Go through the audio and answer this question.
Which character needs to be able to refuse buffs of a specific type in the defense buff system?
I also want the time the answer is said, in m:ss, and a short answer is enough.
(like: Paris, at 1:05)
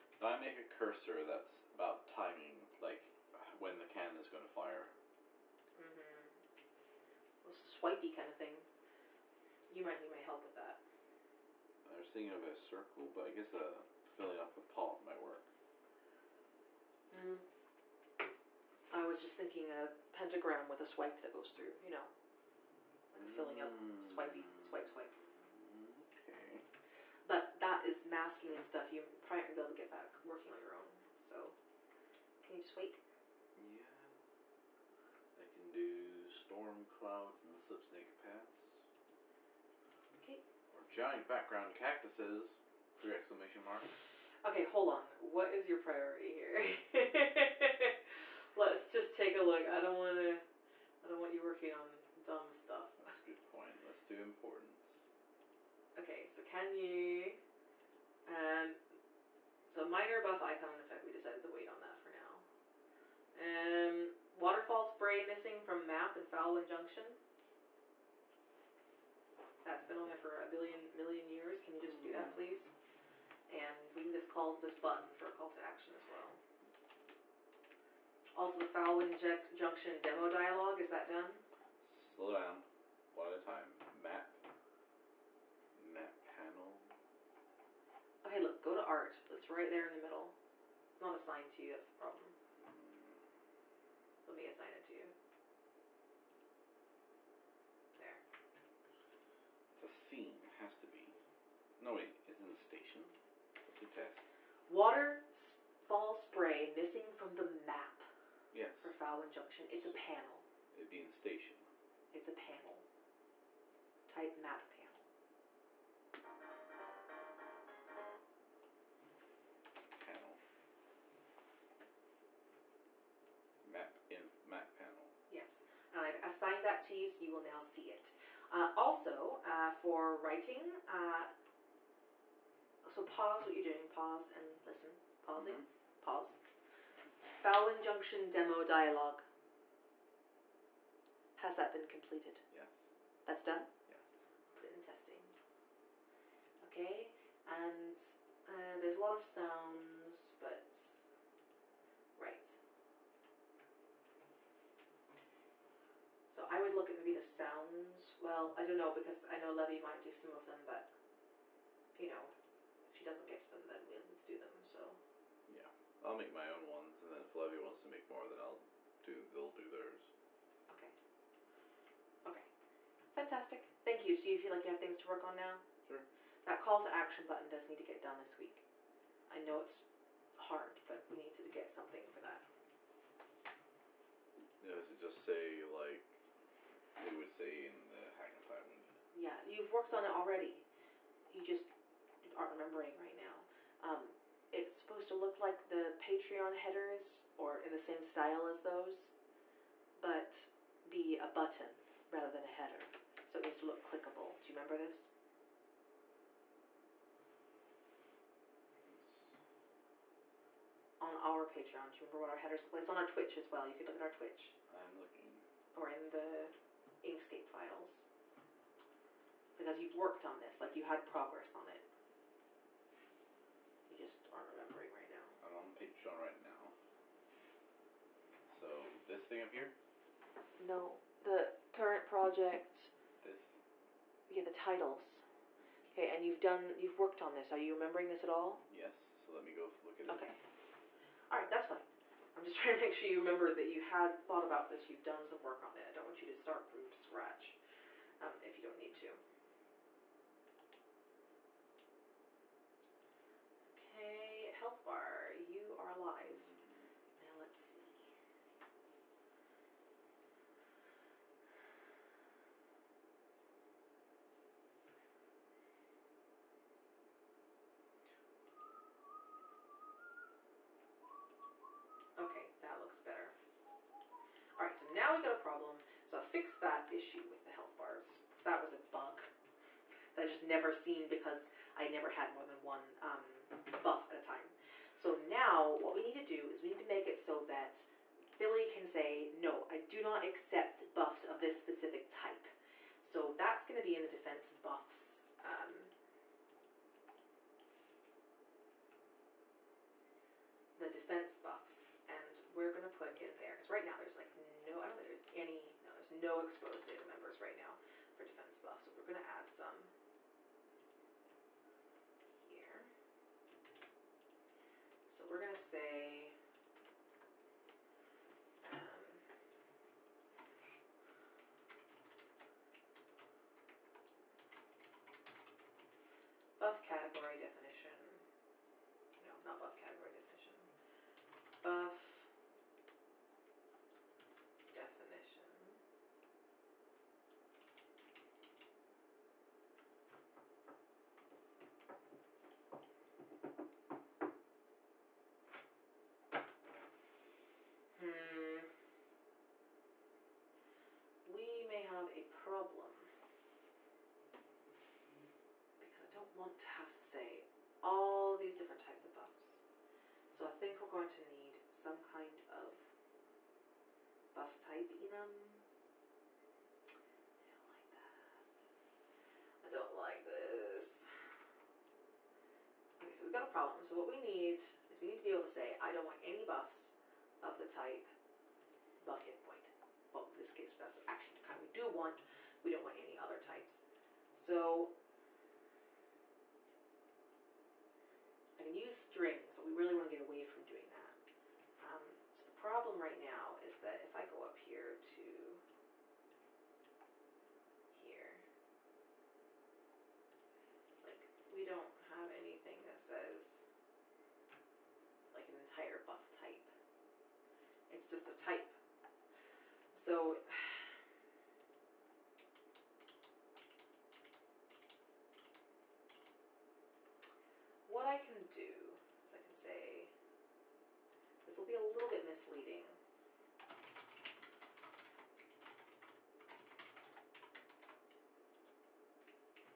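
Billy, at 4:48.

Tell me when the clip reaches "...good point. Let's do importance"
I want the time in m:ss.
0:53.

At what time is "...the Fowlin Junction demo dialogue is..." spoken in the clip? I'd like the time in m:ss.
1:18.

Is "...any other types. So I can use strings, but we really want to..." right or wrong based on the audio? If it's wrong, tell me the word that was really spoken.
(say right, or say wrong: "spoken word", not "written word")
right.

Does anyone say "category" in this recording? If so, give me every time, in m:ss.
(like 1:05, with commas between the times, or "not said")
5:26.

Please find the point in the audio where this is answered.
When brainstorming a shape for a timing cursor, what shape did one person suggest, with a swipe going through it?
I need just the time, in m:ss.
0:20.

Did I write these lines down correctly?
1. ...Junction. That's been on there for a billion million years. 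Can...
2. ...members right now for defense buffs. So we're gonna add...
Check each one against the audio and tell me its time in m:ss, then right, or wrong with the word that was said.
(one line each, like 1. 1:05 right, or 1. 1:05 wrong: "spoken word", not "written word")
1. 1:06 right
2. 5:07 right.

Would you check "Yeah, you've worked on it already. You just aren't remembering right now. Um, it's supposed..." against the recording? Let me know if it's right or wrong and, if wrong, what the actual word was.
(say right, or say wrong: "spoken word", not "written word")
right.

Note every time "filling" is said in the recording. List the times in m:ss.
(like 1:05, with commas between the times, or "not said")
0:14, 0:23.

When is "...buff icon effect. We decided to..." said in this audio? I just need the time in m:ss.
1:00.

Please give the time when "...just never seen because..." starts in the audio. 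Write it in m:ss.
4:40.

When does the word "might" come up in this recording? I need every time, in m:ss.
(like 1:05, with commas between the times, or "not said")
0:09, 0:15, 2:39.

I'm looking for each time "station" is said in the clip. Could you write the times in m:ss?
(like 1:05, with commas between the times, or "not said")
1:42, 1:51.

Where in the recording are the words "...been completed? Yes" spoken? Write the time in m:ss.
2:21.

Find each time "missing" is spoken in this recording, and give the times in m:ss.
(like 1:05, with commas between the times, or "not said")
1:05, 1:46.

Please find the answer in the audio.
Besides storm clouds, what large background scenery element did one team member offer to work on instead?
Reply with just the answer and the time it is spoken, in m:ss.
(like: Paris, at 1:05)
giant background cactuses, at 0:40.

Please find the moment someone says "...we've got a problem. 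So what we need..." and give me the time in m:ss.
6:13.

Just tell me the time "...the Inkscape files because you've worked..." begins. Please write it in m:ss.
3:36.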